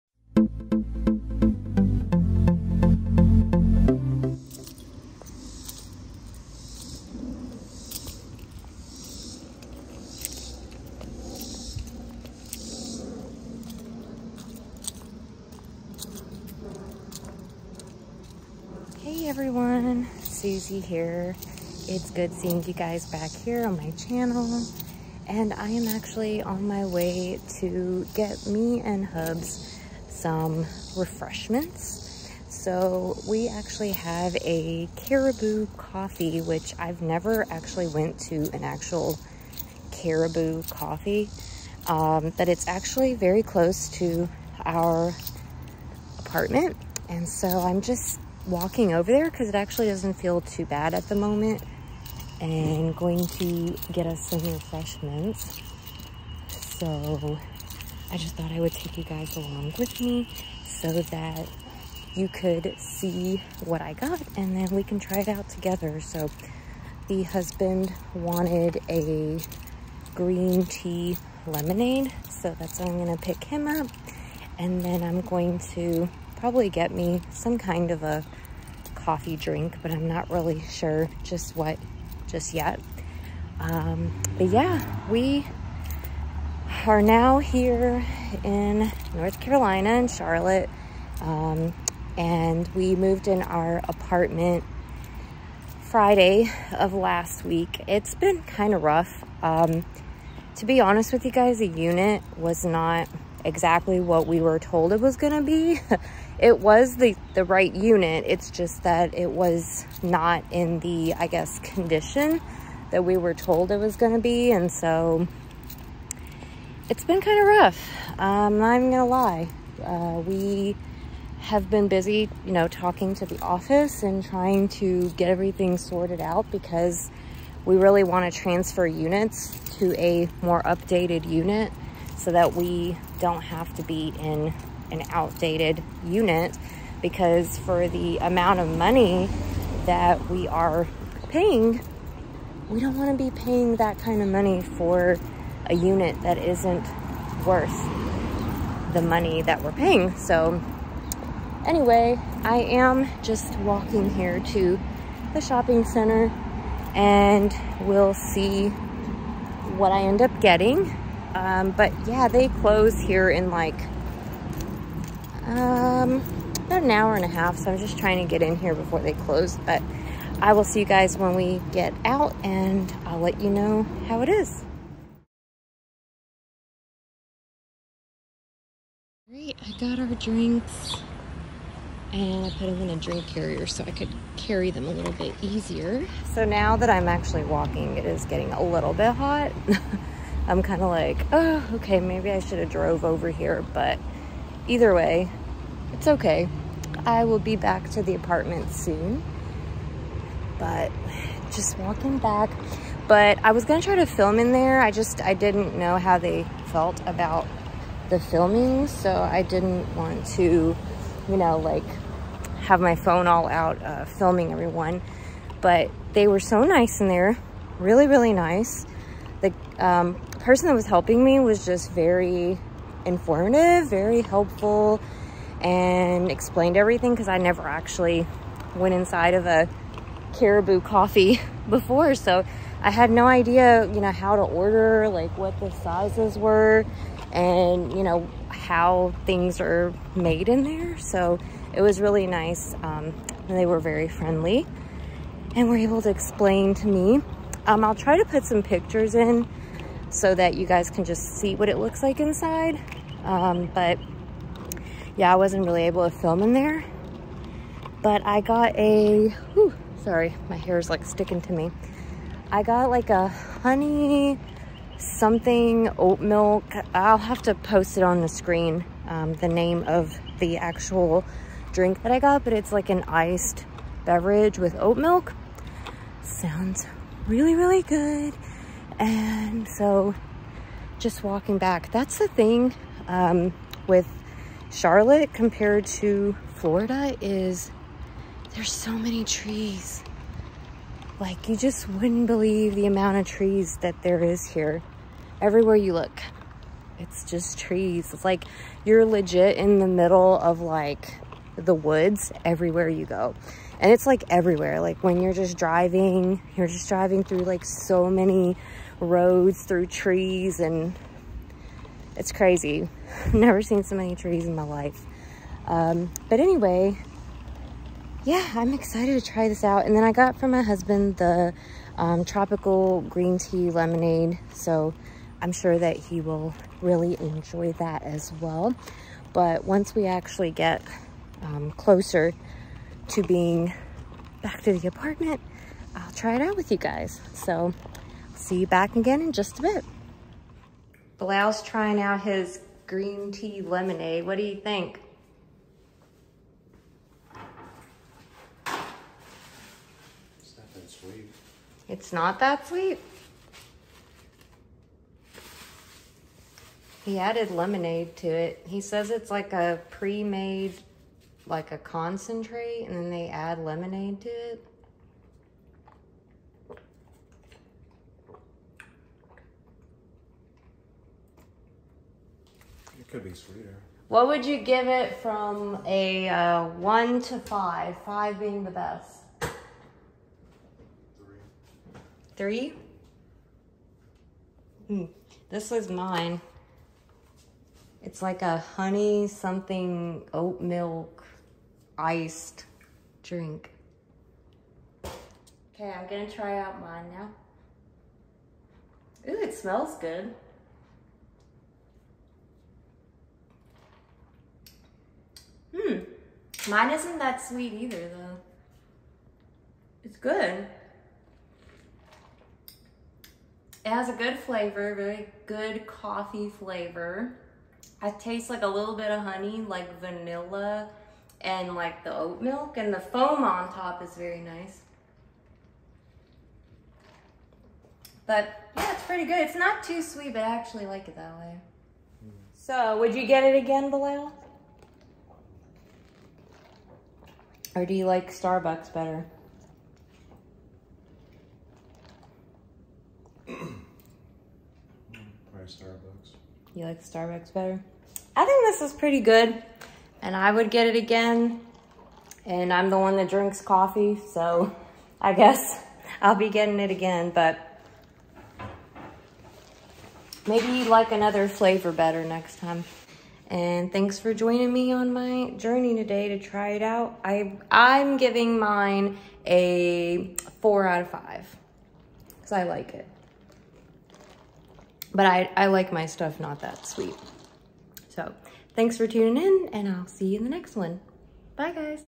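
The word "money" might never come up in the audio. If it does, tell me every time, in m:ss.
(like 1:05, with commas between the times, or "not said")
2:18, 2:24, 2:29.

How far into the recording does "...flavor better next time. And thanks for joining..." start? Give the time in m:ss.
7:41.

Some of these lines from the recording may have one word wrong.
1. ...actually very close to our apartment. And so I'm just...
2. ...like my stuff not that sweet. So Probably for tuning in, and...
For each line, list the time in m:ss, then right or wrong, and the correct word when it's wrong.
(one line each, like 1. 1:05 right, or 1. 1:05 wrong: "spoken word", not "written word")
1. 0:42 right
2. 7:55 wrong: "Thanks", not "Probably".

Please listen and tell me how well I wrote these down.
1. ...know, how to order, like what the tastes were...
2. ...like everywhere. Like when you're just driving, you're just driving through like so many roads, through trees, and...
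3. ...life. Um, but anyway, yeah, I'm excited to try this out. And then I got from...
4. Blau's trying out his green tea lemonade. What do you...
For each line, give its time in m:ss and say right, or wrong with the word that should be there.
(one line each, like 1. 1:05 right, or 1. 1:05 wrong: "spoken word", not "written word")
1. 3:54 wrong: "sizes", not "tastes"
2. 5:04 right
3. 5:14 right
4. 5:41 right.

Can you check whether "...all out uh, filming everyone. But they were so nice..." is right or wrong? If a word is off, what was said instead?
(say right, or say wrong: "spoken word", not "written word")
right.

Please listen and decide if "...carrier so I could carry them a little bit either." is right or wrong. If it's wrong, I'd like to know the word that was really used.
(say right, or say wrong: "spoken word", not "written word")
wrong: "easier", not "either".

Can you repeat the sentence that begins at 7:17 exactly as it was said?
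Or do you like Starbucks better?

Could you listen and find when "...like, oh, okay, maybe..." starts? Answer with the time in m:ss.
3:10.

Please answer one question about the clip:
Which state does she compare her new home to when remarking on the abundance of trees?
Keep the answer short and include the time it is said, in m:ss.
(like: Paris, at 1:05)
Florida, at 4:46.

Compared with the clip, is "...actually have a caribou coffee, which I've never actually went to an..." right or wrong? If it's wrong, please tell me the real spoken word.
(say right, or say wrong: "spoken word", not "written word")
right.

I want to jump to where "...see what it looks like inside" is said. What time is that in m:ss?
4:11.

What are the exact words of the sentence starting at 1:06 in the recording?
So the husband wanted a green tea lemonade.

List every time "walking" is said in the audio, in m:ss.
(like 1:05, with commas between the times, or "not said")
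0:48, 2:33, 3:07, 3:21, 4:41.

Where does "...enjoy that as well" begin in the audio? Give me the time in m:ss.
5:27.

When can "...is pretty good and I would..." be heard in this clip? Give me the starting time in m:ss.
7:28.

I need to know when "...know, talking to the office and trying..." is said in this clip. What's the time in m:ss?
2:02.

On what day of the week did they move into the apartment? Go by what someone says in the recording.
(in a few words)
Friday.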